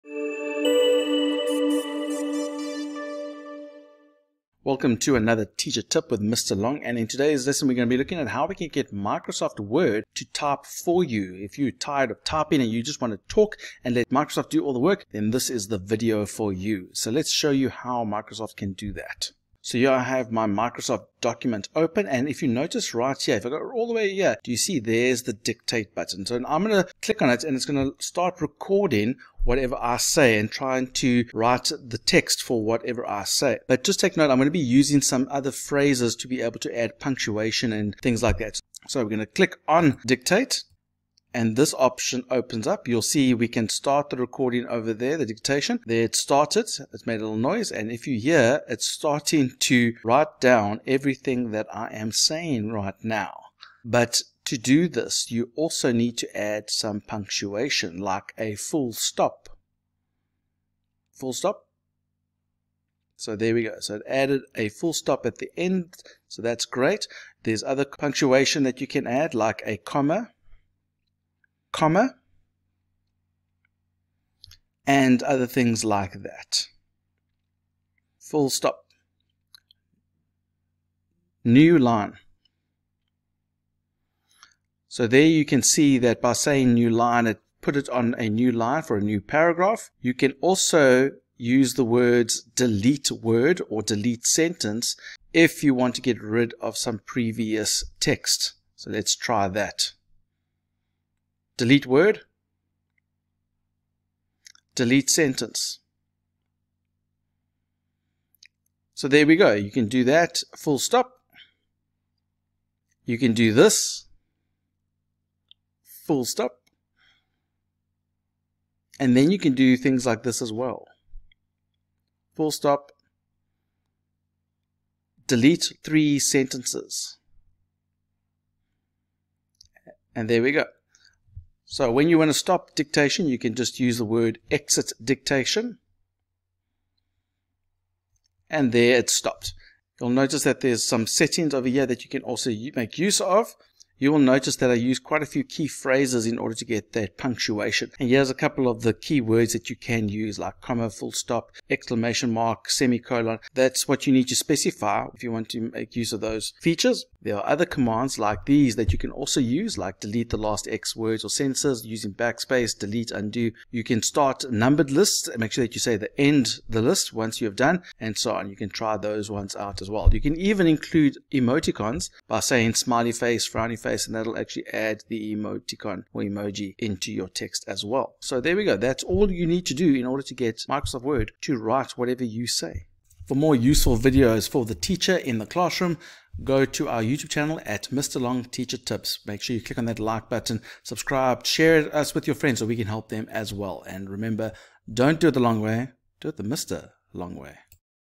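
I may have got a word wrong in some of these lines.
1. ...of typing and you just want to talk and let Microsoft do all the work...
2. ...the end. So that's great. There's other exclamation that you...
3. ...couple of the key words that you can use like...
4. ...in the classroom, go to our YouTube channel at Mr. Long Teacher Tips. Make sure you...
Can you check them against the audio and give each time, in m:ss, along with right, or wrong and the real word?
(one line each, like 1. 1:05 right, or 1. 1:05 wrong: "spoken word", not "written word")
1. 0:12 right
2. 1:05 wrong: "punctuation", not "exclamation"
3. 2:28 right
4. 3:05 right.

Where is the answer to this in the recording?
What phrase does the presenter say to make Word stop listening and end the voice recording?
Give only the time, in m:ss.
2:14.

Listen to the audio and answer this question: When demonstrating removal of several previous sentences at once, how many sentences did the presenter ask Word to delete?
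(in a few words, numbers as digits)
3.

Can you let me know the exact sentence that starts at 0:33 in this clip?
But just take note, I'm going to be using some other phrases to be able to add punctuation and things like that.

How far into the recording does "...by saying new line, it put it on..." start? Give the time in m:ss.
1:26.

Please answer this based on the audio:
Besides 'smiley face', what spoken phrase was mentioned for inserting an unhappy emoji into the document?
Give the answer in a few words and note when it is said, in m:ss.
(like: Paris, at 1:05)
frowny face, at 2:53.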